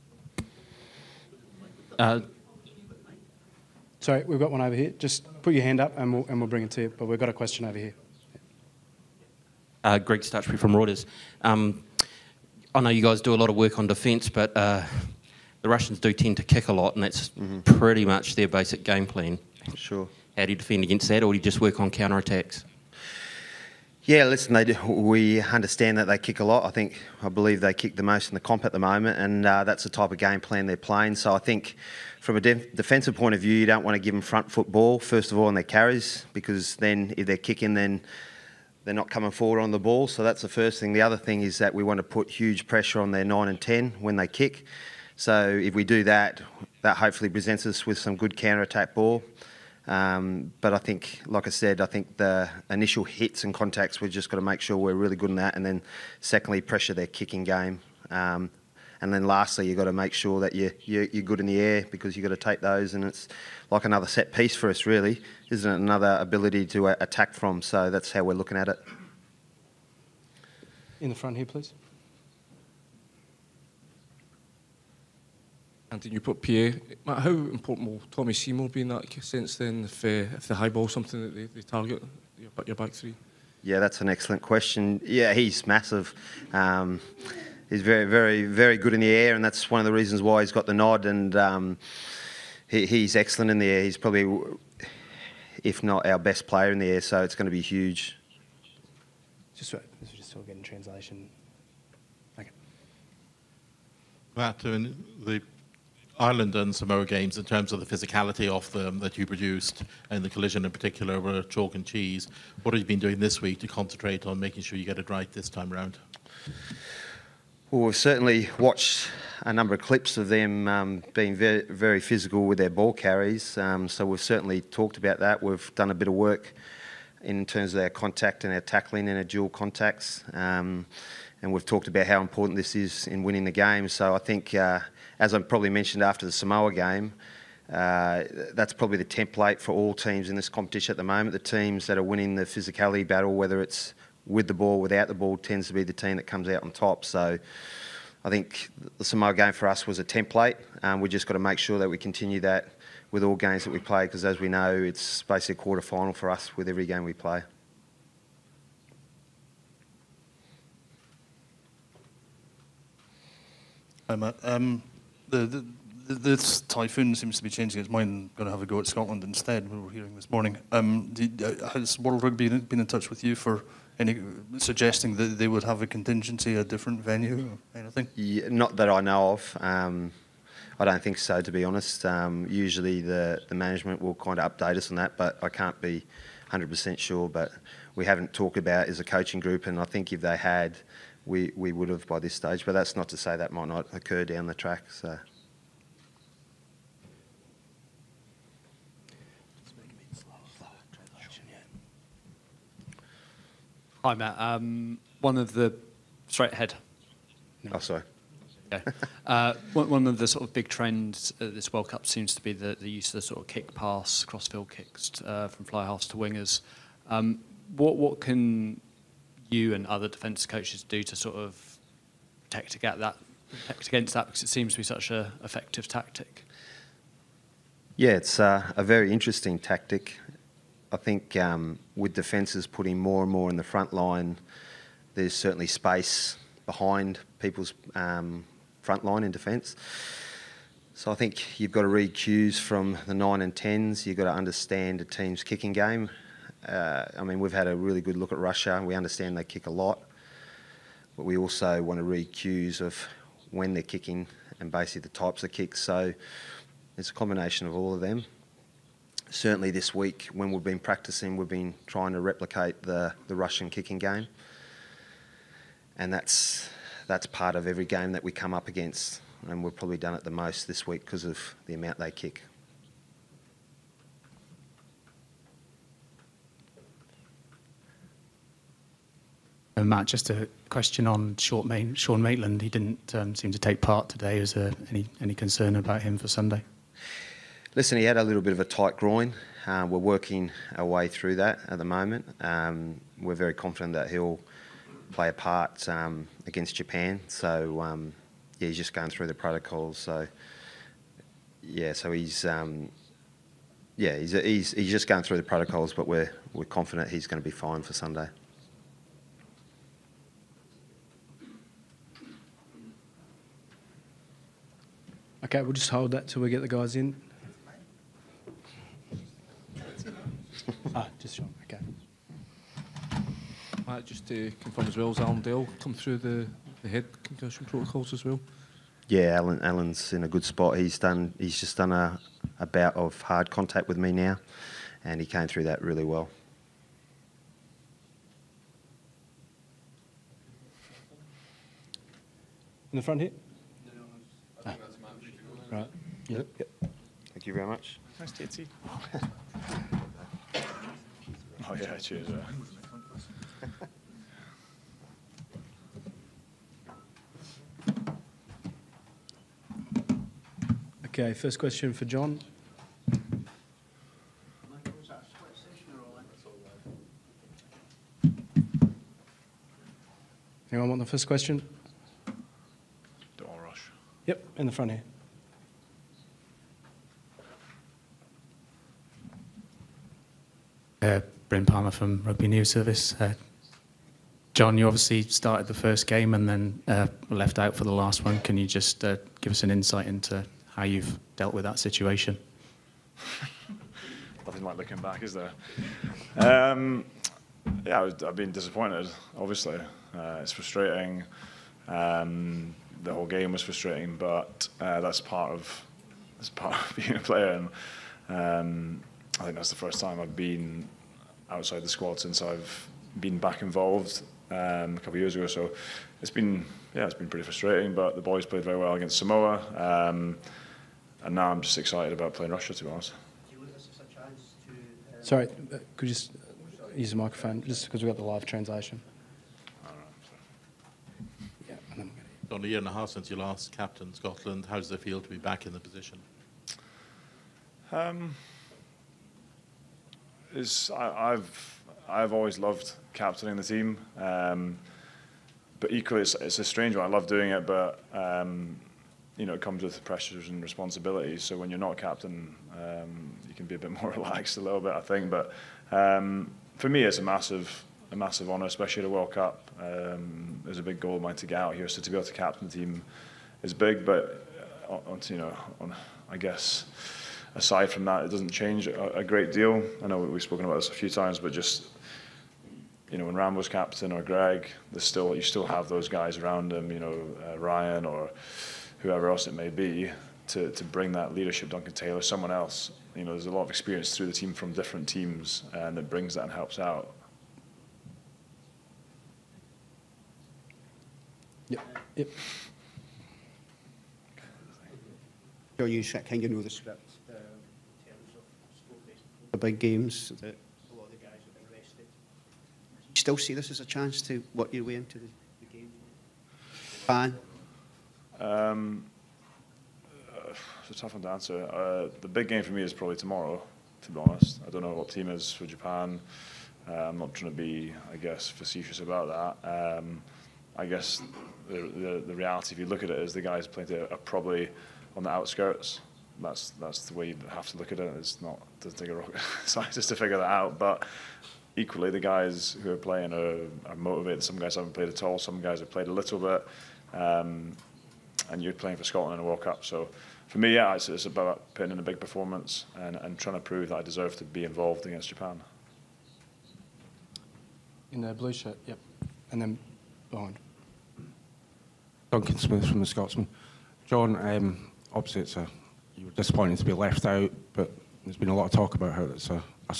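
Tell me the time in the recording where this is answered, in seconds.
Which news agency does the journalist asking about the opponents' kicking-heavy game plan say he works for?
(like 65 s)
10 s.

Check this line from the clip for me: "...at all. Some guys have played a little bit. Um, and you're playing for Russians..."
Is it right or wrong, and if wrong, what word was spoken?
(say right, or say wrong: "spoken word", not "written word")
wrong: "Scotland", not "Russians".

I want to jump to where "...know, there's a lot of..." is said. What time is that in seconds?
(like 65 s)
483 s.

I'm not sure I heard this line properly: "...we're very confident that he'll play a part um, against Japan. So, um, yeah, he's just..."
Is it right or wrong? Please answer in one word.
right.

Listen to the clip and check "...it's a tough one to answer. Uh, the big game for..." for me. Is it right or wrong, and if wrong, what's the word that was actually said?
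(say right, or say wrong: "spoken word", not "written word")
right.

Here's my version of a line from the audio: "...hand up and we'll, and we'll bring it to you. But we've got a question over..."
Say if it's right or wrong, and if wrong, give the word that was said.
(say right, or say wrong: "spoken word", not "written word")
right.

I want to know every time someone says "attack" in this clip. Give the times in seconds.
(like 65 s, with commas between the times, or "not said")
22 s, 48 s, 67 s.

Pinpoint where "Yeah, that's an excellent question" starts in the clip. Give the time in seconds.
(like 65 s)
83 s.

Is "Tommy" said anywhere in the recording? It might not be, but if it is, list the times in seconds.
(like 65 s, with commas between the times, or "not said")
78 s.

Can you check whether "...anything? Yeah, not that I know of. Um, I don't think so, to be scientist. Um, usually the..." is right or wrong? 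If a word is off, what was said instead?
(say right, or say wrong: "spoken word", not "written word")
wrong: "honest", not "scientist".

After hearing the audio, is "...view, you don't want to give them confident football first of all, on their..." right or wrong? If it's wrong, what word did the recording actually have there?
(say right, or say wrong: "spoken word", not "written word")
wrong: "front", not "confident".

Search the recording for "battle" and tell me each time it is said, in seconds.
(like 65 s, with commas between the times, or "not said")
143 s.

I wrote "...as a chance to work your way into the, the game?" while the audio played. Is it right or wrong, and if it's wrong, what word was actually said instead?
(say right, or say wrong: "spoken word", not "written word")
right.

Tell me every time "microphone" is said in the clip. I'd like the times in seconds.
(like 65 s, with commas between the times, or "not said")
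427 s.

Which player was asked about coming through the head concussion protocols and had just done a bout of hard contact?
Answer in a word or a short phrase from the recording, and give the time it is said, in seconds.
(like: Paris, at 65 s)
Allan Dell, at 325 s.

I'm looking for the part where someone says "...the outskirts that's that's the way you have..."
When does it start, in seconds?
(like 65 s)
525 s.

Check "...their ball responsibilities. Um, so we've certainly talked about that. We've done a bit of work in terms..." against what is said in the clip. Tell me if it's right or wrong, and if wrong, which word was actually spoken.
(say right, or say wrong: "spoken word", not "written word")
wrong: "carries", not "responsibilities".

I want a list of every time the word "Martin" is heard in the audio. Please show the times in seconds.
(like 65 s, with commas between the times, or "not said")
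104 s.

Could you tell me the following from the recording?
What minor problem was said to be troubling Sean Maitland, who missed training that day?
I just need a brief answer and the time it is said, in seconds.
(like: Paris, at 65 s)
Tight groin, at 288 s.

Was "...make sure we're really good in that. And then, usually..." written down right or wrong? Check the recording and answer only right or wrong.
wrong.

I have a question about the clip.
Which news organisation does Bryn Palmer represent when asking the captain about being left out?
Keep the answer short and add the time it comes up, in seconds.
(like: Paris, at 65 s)
Rugby News Service, at 382 s.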